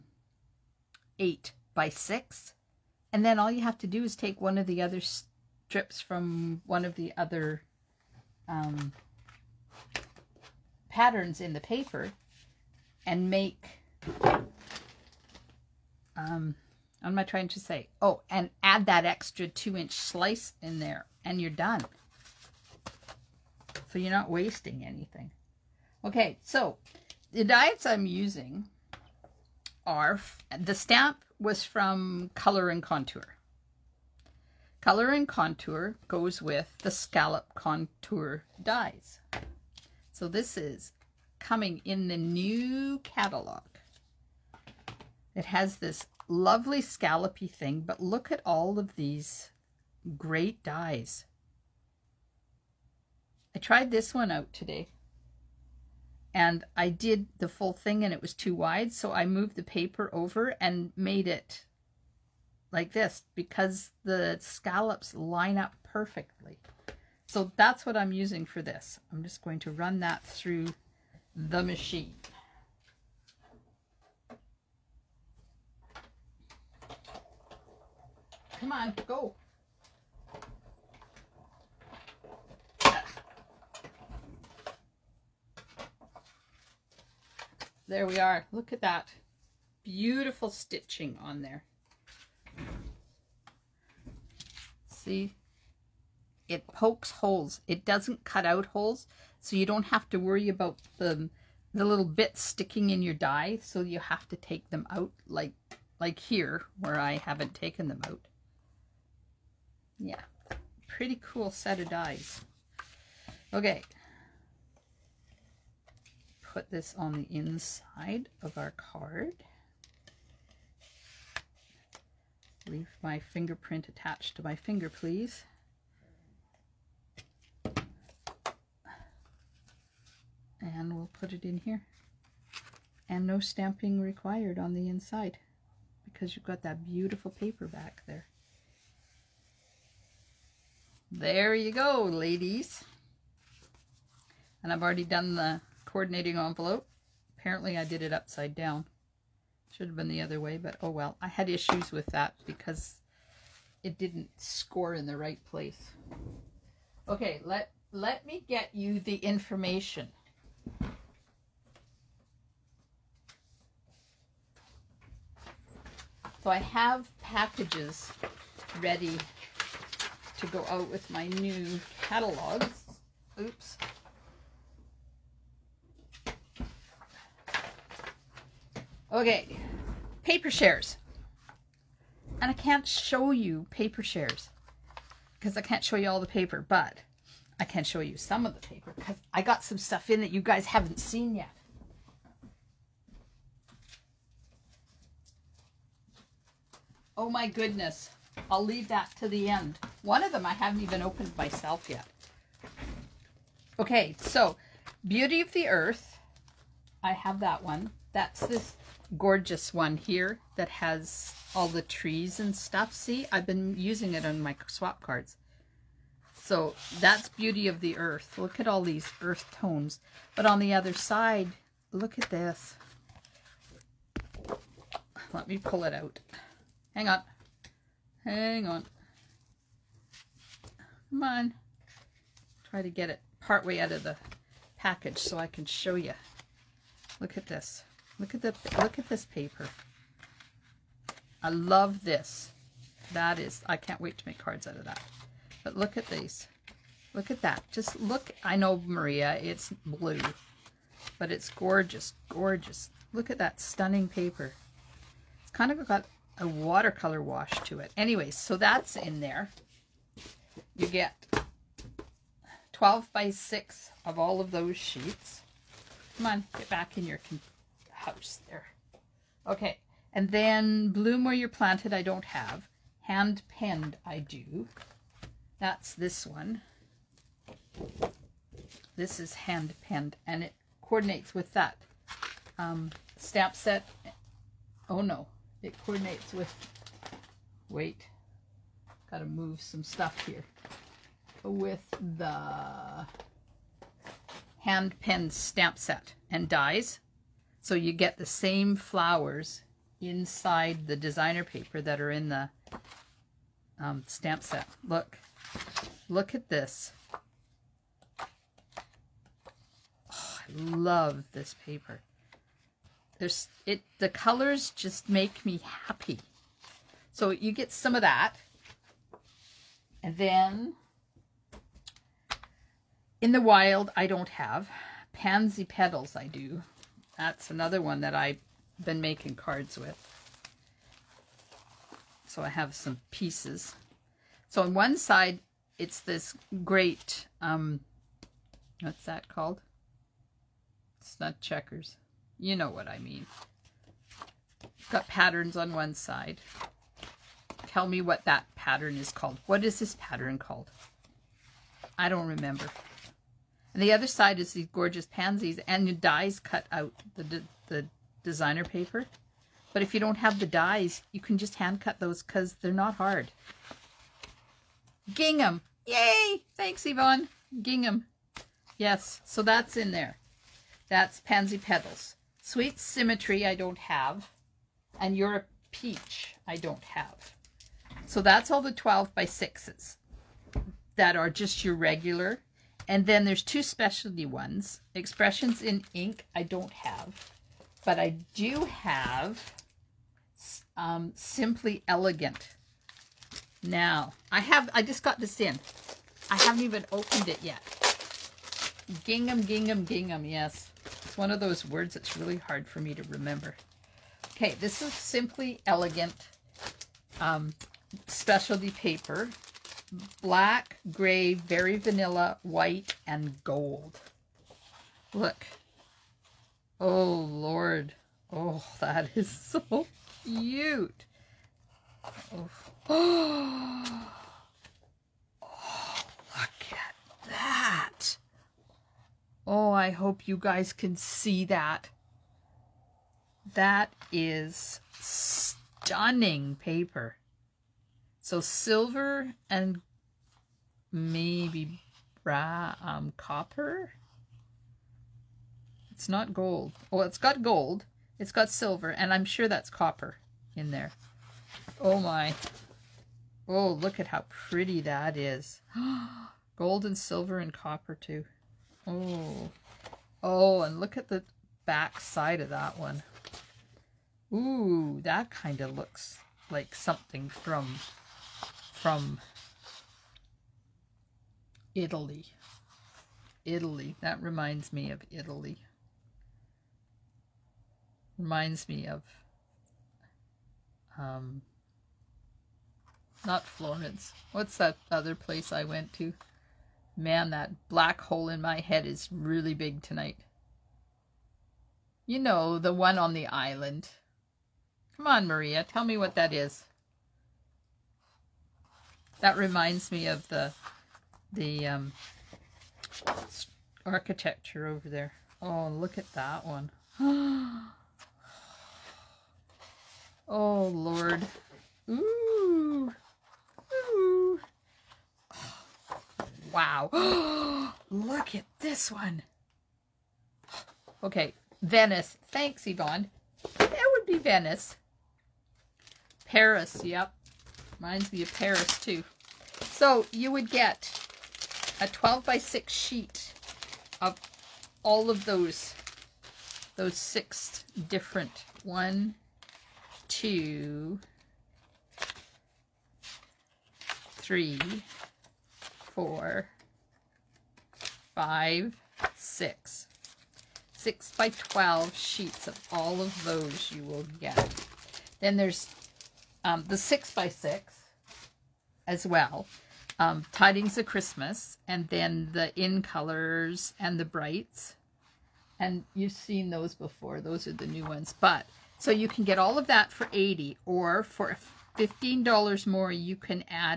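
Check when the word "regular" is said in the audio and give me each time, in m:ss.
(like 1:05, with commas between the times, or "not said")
6:21.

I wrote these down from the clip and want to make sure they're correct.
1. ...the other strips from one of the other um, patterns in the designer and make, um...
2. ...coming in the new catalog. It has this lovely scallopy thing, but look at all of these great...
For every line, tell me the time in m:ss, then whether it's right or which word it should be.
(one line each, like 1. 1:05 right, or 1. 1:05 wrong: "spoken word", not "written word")
1. 0:04 wrong: "paper", not "designer"
2. 0:41 right.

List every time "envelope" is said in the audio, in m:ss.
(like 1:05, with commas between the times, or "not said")
2:26.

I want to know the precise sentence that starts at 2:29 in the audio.
Should have been the other way, but oh well.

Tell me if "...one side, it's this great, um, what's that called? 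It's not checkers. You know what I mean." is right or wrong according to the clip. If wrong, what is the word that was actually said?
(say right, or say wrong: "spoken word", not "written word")
right.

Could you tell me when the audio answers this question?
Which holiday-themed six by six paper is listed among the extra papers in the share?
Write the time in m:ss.
9:20.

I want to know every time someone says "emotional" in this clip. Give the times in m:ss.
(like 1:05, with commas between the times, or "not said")
not said.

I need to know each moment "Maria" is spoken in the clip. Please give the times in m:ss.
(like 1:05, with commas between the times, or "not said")
4:08, 8:15.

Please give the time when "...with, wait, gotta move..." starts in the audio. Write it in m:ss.
4:46.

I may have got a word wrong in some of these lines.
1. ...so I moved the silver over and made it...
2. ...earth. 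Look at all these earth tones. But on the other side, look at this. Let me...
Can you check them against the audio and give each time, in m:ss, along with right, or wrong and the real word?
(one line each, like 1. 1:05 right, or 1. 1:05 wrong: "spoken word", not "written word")
1. 0:58 wrong: "paper", not "silver"
2. 3:37 right.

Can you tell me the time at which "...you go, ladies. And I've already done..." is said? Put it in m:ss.
2:21.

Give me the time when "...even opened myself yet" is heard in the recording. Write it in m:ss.
3:20.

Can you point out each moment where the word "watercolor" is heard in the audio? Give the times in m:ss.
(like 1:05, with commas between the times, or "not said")
4:16.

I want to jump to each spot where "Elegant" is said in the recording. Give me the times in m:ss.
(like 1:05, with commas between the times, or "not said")
6:31, 6:45.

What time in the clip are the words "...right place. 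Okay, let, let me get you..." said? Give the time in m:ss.
2:35.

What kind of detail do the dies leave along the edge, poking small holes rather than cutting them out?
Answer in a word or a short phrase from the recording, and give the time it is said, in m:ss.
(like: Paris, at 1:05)
Stitching, at 1:30.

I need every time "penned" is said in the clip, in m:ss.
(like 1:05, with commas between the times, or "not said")
4:33, 4:39, 4:55.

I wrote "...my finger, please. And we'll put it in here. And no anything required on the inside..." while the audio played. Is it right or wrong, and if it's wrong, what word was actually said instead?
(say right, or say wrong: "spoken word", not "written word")
wrong: "stamping", not "anything".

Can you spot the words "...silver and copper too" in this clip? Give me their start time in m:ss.
7:36.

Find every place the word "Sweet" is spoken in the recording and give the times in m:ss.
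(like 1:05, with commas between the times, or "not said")
6:12.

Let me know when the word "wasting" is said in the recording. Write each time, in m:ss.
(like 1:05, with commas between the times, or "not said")
0:24.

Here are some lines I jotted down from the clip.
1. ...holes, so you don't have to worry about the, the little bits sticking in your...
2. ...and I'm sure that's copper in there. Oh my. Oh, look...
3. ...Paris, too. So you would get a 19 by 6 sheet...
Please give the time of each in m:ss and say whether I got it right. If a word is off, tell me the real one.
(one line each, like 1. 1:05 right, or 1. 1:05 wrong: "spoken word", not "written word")
1. 1:38 right
2. 7:28 right
3. 8:48 wrong: "12", not "19".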